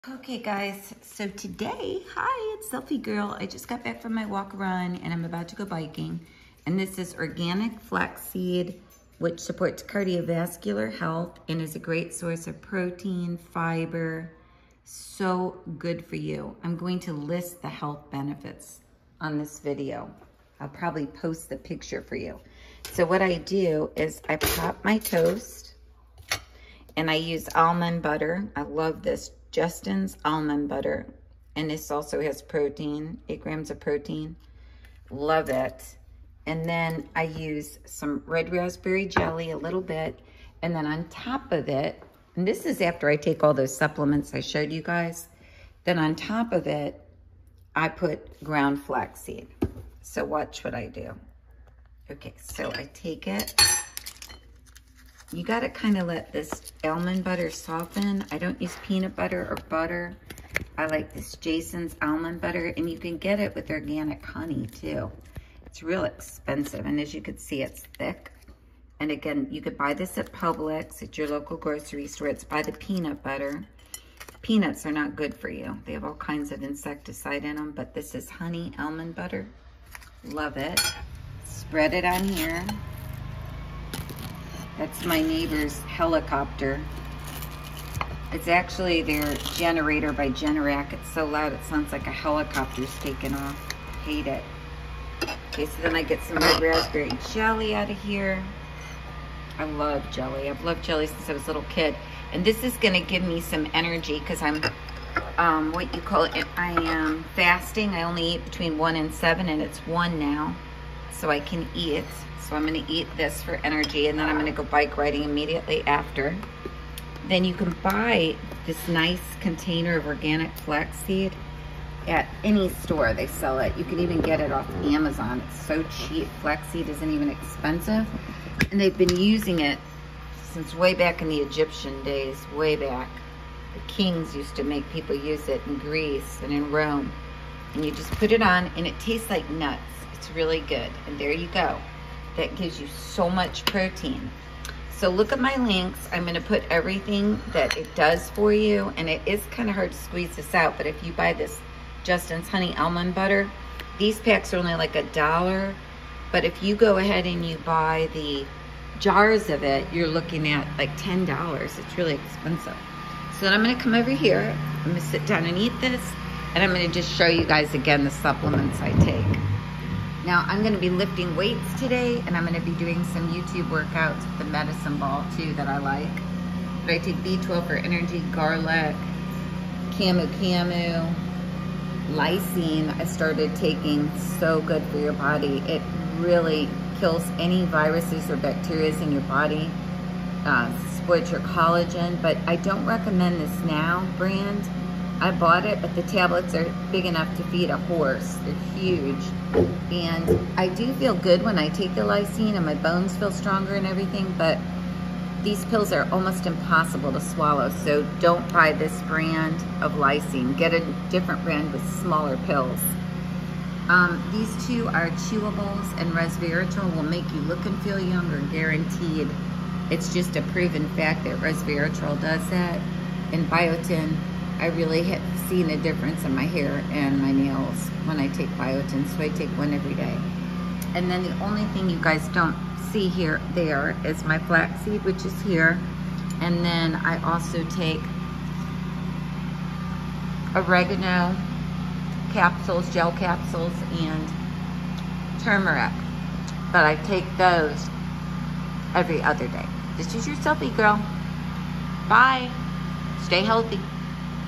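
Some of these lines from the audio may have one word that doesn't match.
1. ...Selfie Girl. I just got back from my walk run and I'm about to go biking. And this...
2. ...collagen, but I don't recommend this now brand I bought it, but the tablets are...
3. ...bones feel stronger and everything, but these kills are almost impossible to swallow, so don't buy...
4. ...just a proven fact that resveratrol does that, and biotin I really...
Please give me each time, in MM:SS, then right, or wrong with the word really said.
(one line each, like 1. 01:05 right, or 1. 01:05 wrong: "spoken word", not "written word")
1. 00:02 right
2. 03:11 right
3. 03:22 wrong: "pills", not "kills"
4. 03:40 right.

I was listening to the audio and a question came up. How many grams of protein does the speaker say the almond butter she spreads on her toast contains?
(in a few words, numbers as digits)
8.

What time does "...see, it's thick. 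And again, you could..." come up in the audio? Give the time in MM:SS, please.
01:07.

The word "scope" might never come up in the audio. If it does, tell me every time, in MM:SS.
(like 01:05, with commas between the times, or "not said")
not said.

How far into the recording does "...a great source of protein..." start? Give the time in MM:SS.
00:11.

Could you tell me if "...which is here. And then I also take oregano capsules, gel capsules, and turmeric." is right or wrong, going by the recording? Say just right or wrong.
right.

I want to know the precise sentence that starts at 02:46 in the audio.
And I'm going to just show you guys again the supplements I take.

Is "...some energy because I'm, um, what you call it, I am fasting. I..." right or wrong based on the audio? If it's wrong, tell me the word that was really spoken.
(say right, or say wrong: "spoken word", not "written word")
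right.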